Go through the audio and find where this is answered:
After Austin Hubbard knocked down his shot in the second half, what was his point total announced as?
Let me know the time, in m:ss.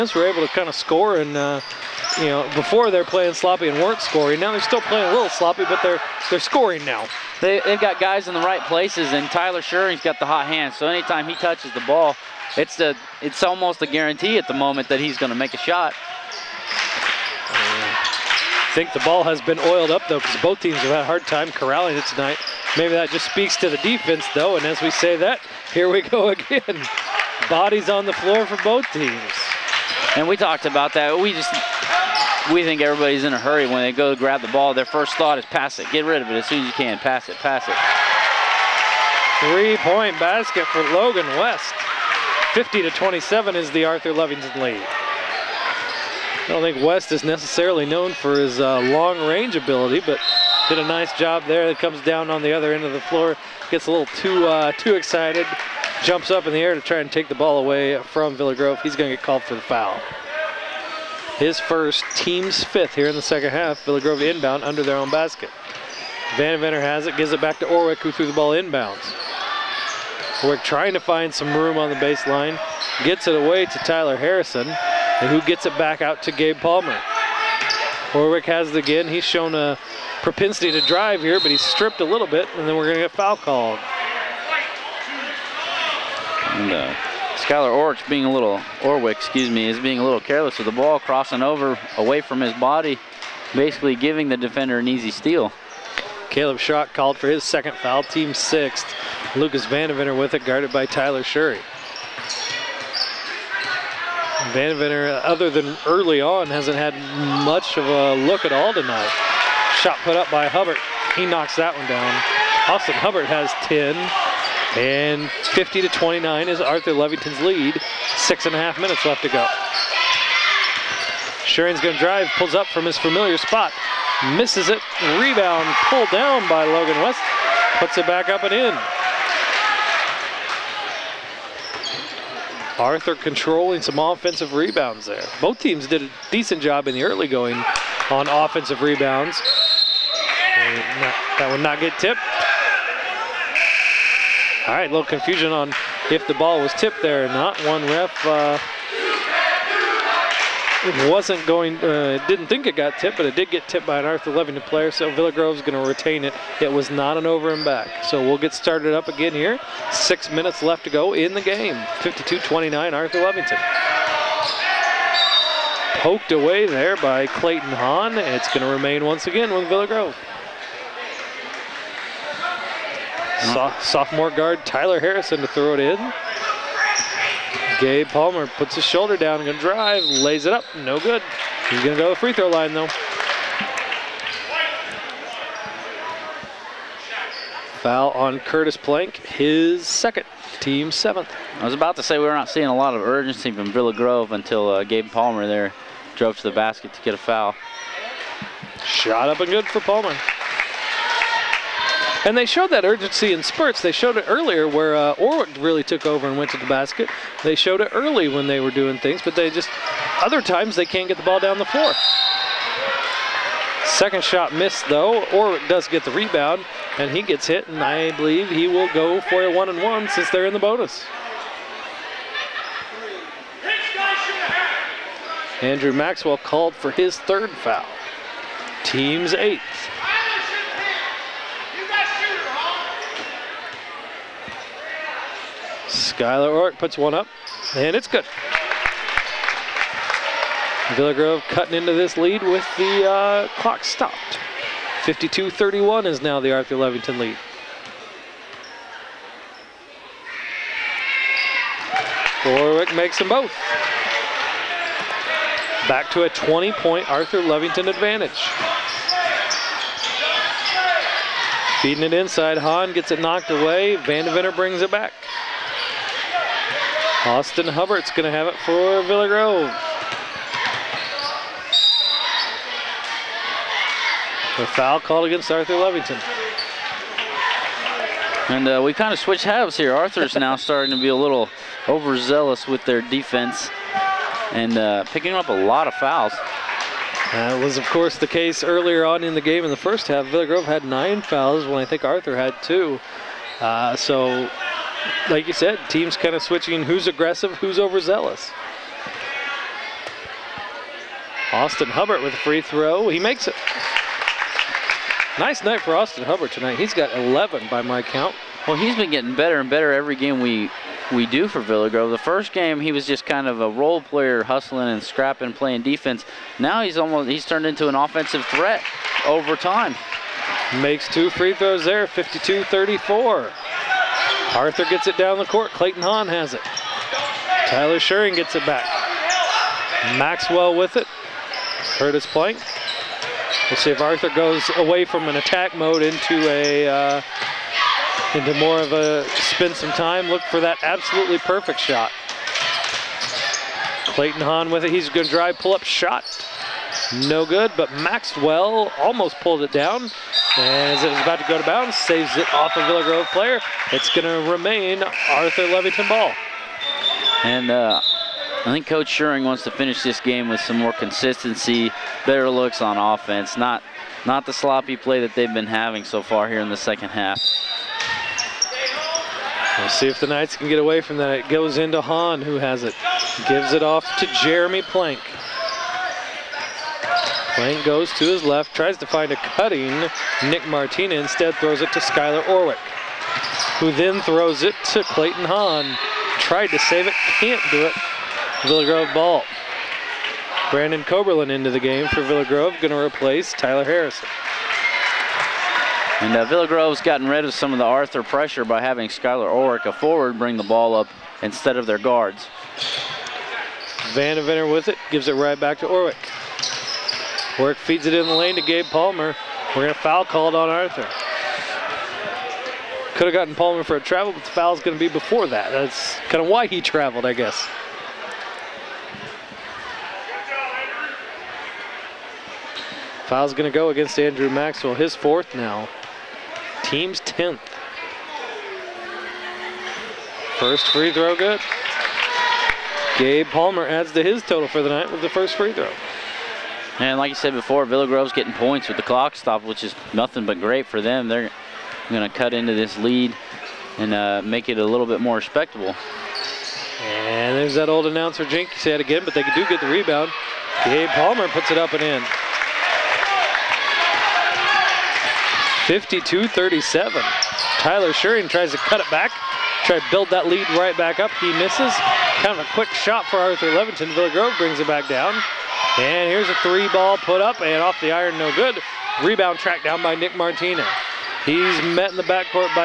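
1:52.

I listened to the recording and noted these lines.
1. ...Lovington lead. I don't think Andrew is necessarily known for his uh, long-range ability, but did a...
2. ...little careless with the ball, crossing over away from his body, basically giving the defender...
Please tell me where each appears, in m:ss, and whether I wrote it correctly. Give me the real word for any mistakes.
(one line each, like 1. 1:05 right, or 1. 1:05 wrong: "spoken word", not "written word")
1. 0:44 wrong: "West", not "Andrew"
2. 1:30 right.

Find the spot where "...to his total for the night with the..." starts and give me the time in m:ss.
7:14.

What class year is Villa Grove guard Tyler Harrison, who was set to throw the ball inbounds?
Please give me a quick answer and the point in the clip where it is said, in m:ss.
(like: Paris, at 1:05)
sophomore, at 2:53.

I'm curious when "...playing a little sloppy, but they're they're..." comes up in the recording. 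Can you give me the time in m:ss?
0:04.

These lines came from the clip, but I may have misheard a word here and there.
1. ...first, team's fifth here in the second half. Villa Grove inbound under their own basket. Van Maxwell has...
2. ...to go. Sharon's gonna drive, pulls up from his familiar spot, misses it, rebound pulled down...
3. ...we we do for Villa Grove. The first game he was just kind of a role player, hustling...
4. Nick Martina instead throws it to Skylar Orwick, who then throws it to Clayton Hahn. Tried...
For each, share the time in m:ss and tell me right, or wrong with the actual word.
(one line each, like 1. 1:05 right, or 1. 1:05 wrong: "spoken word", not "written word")
1. 1:01 wrong: "Venter", not "Maxwell"
2. 1:59 right
3. 5:10 right
4. 6:20 right.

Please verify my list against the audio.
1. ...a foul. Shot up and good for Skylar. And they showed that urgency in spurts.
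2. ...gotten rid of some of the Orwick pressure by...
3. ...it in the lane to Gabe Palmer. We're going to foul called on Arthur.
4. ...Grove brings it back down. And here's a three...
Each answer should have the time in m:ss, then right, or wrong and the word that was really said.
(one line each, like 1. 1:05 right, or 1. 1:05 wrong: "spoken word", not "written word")
1. 3:17 wrong: "Palmer", not "Skylar"
2. 6:37 wrong: "Arthur", not "Orwick"
3. 6:48 right
4. 7:44 right.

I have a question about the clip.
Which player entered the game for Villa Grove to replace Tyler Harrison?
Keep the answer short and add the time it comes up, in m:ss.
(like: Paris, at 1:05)
Brandon Coberlin, at 6:30.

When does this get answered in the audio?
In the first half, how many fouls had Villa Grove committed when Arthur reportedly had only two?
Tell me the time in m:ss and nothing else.
4:50.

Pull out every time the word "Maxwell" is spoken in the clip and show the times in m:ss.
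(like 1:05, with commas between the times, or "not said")
3:45, 5:30, 5:47, 7:04.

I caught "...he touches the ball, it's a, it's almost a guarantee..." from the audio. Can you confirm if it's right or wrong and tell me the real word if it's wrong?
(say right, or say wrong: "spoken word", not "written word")
right.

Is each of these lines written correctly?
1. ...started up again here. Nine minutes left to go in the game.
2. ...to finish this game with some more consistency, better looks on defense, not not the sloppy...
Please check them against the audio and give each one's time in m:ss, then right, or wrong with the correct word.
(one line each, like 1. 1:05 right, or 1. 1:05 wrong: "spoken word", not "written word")
1. 2:38 wrong: "Six", not "Nine"
2. 5:59 wrong: "offense", not "defense".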